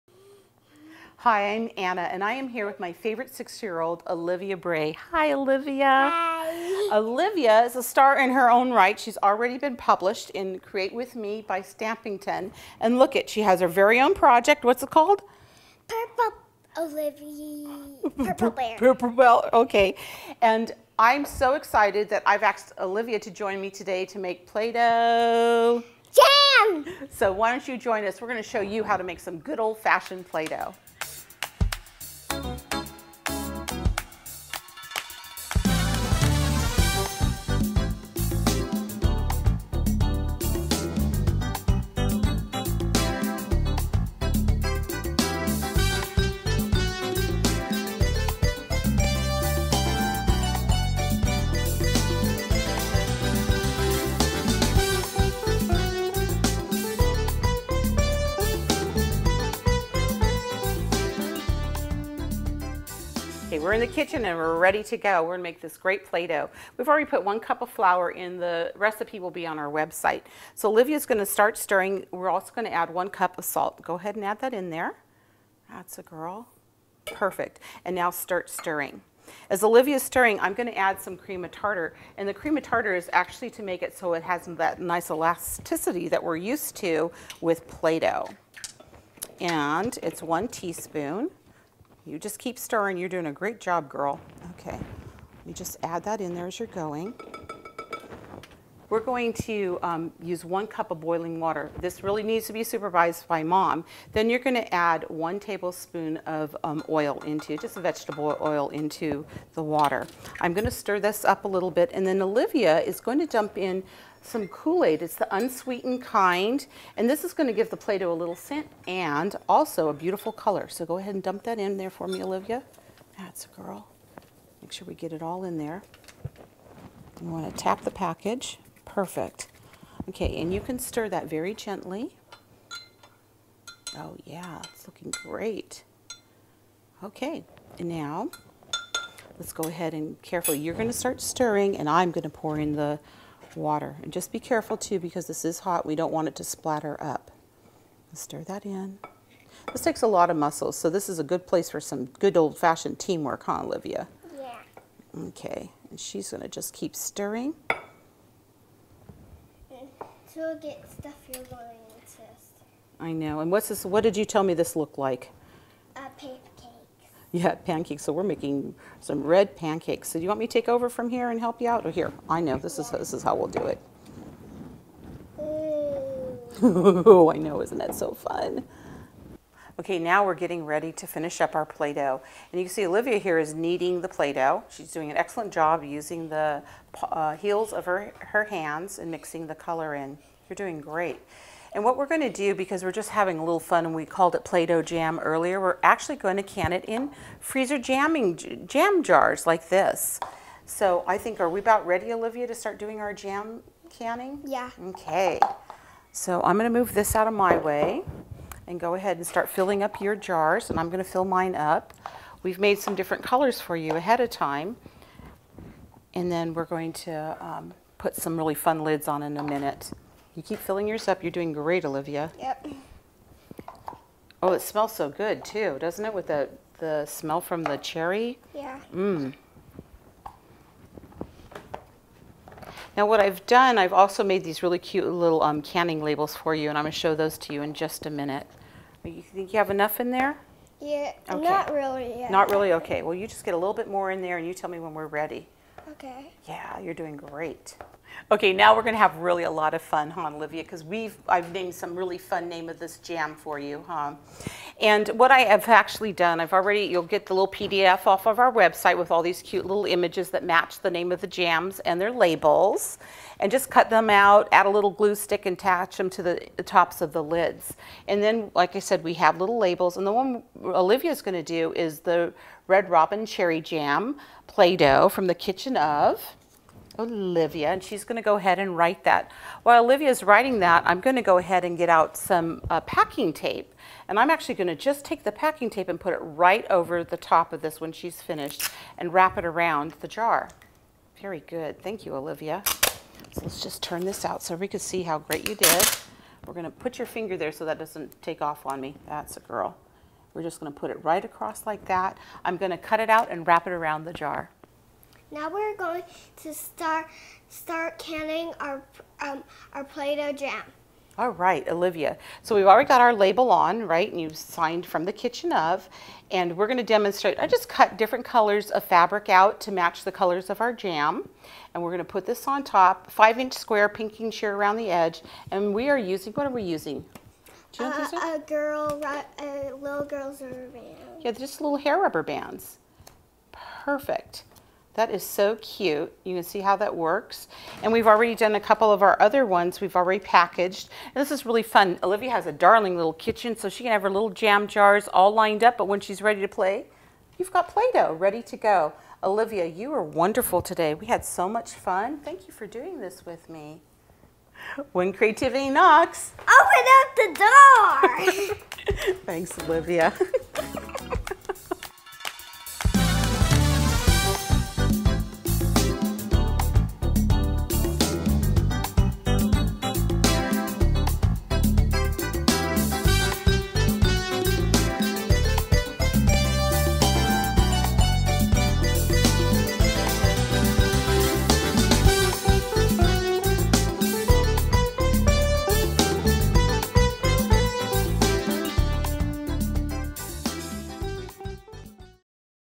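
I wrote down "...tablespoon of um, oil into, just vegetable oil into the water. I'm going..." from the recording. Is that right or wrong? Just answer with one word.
right.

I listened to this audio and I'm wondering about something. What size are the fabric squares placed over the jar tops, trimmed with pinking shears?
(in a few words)
5 inch.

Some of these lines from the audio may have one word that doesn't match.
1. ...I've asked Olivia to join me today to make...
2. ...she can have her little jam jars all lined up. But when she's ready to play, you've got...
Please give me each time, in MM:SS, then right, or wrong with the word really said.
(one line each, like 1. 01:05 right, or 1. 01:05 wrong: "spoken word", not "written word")
1. 00:22 right
2. 05:43 right.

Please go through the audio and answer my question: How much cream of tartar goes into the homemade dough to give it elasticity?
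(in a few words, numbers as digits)
1 teaspoon.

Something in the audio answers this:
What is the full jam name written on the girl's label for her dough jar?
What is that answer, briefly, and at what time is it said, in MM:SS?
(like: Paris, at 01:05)
Red Robin Cherry Jam, at 04:32.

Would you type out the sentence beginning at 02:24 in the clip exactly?
And just be careful too because this is hot, we don't want it to splatter up.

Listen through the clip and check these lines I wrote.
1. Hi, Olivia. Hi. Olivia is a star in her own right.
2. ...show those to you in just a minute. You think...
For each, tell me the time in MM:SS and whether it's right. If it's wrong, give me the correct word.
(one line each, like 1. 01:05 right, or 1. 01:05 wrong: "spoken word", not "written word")
1. 00:05 right
2. 03:56 right.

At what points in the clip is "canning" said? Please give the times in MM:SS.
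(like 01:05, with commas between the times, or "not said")
03:23, 03:55, 05:07.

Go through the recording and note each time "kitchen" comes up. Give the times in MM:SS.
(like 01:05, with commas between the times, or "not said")
01:03, 04:35, 05:15, 05:43.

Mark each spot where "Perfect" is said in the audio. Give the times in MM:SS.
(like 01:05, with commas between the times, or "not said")
01:17, 02:08, 05:33.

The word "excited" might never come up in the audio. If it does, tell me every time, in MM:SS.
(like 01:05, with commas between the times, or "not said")
00:21.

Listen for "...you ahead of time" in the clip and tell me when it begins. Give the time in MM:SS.
03:33.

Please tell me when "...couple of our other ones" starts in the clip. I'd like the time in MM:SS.
05:38.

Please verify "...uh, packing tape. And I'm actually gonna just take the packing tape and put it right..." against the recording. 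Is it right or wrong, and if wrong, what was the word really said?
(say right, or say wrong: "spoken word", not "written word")
right.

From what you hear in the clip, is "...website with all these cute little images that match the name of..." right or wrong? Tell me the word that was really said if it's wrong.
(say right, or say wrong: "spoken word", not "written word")
right.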